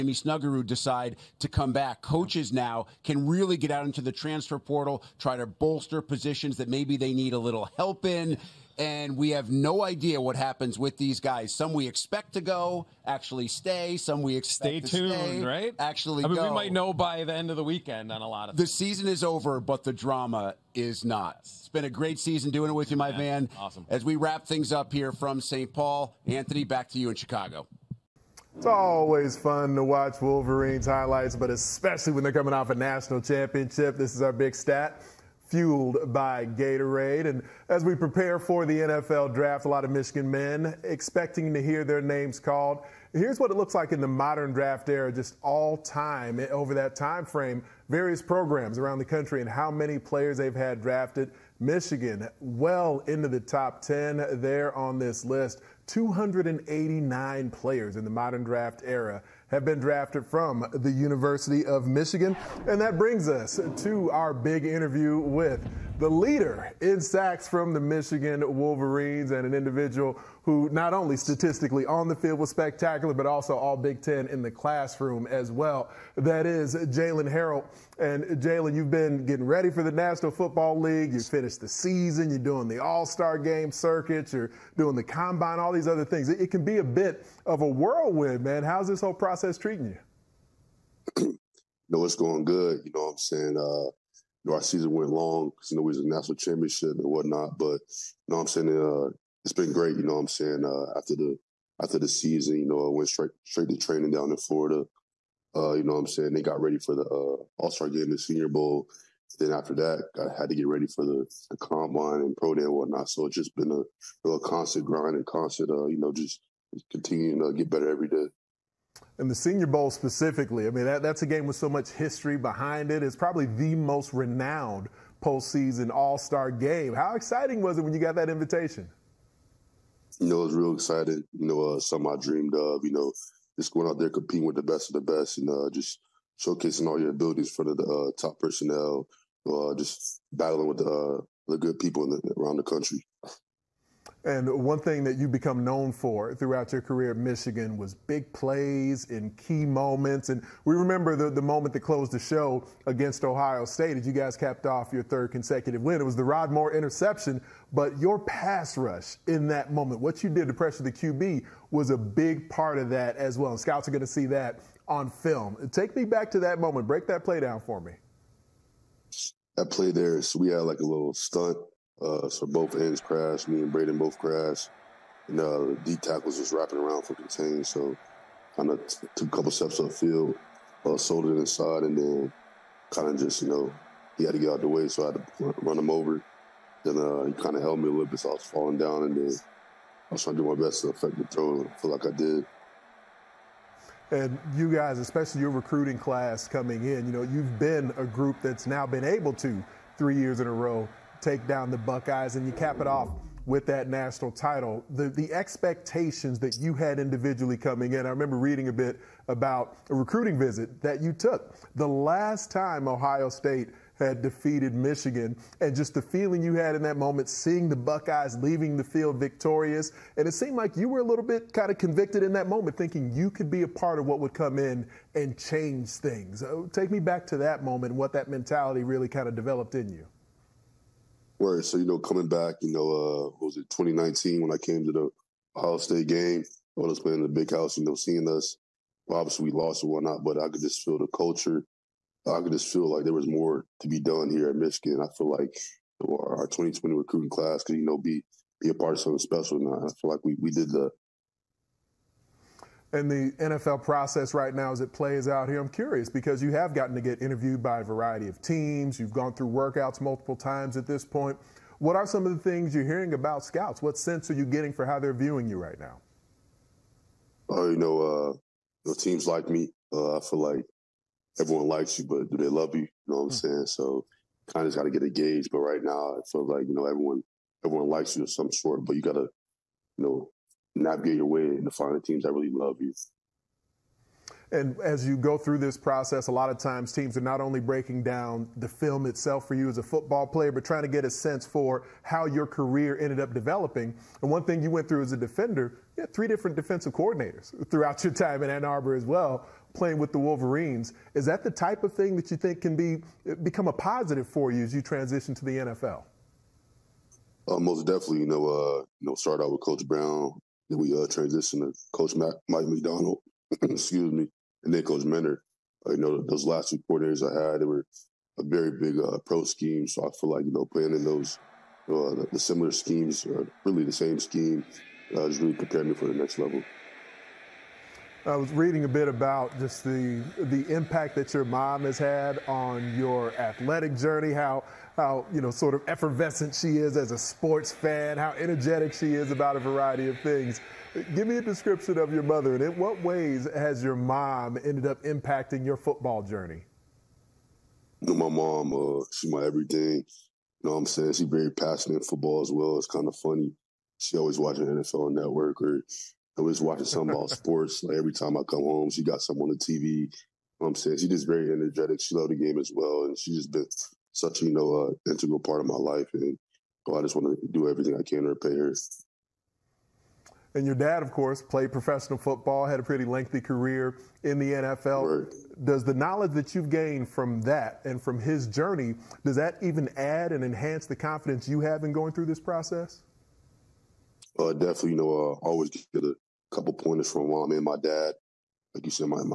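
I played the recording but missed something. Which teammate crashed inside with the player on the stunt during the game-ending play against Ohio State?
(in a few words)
Braiden.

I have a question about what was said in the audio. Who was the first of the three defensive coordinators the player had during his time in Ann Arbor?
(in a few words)
Coach Brown.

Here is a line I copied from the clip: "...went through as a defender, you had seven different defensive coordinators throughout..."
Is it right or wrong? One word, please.
wrong.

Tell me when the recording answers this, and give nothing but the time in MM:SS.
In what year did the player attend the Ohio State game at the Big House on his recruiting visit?
03:53.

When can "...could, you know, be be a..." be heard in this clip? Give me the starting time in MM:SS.
04:07.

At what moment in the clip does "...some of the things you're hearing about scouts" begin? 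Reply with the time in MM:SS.
04:22.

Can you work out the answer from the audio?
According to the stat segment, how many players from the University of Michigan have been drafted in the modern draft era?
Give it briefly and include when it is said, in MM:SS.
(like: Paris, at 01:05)
289, at 00:55.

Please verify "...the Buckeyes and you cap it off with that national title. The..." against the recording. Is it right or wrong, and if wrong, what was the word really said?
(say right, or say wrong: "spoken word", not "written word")
right.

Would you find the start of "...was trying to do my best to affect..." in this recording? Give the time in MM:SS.
03:10.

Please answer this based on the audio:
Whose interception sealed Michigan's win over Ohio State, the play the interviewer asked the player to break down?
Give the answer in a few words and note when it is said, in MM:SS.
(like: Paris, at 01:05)
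Rod Moore, at 02:36.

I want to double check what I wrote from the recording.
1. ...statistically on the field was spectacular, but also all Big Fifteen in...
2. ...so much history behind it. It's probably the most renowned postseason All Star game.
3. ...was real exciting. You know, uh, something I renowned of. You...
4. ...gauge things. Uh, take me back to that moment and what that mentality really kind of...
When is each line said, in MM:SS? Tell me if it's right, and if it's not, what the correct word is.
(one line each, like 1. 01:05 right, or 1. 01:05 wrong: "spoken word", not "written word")
1. 01:11 wrong: "Ten", not "Fifteen"
2. 02:01 right
3. 02:10 wrong: "dreamed", not "renowned"
4. 03:45 wrong: "change", not "gauge".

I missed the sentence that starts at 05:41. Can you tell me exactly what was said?
Give me a description of your mother, and in what ways has your mom ended up impacting your football journey?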